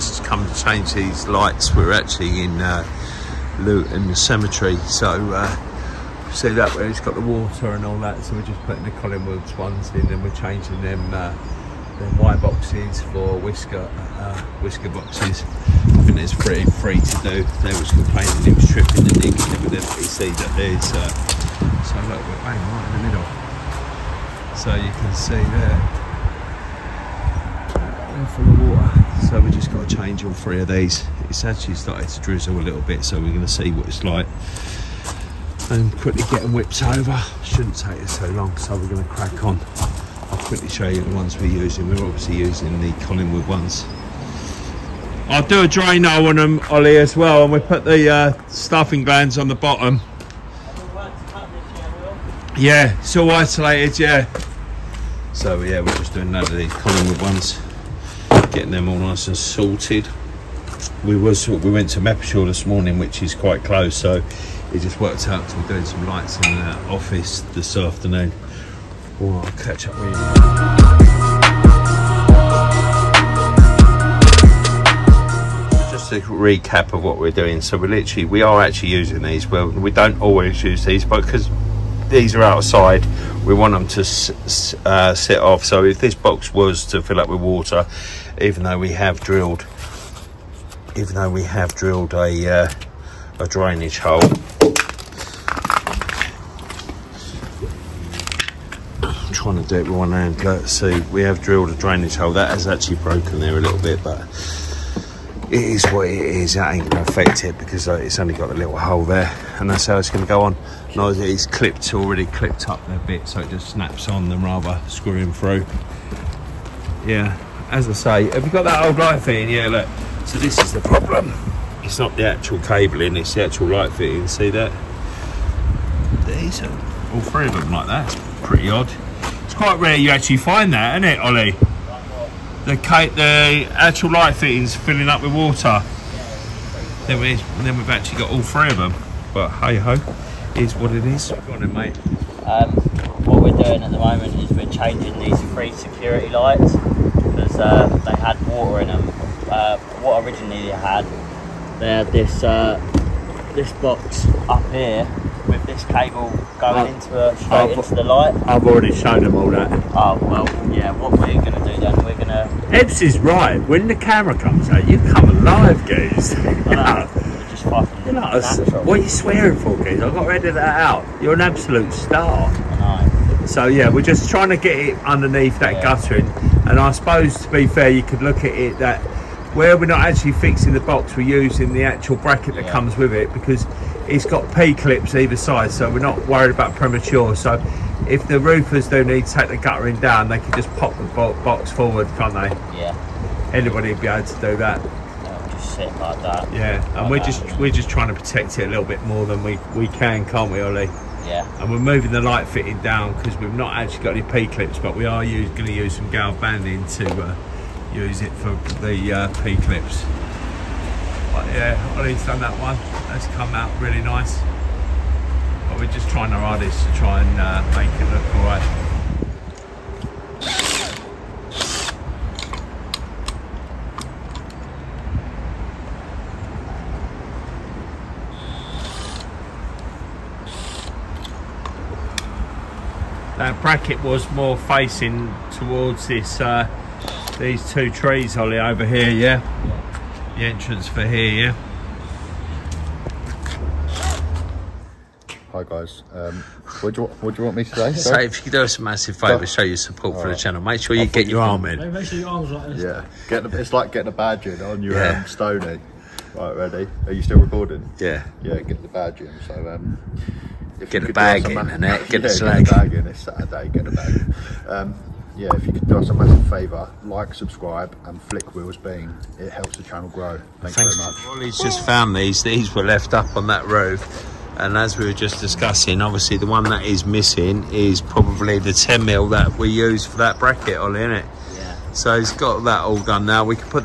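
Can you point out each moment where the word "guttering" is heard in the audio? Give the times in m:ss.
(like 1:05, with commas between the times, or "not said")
2:55, 3:09.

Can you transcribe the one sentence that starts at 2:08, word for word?
It's pretty odd quite rare you actually find that, isn't it, Ollie?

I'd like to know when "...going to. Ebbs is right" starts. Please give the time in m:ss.
2:42.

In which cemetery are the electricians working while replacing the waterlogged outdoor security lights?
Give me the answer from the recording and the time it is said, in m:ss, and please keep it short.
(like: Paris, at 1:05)
Luton Cemetery, at 0:03.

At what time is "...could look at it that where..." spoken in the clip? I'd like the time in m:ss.
2:58.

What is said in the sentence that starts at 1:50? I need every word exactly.
Now it's clipped already, clipped up a bit, so it just snaps on than rather screwing through.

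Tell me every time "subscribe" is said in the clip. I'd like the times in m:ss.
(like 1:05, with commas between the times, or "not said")
4:27.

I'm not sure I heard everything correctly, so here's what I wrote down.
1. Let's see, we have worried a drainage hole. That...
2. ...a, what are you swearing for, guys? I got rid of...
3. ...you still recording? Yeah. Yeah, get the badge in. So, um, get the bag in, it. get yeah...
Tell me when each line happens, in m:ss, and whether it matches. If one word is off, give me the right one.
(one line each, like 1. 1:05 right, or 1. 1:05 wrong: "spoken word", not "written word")
1. 1:40 wrong: "drilled", not "worried"
2. 2:48 right
3. 4:17 right.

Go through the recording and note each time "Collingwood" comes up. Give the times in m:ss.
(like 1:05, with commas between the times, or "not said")
0:08, 0:43, 0:56.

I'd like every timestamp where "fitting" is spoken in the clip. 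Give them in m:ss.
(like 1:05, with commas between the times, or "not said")
1:59, 2:03, 2:14, 3:22.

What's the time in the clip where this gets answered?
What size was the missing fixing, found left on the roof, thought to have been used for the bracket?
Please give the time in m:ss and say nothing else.
4:38.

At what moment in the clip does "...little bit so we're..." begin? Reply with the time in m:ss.
0:32.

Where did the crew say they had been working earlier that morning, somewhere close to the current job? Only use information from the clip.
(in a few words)
Mappishore.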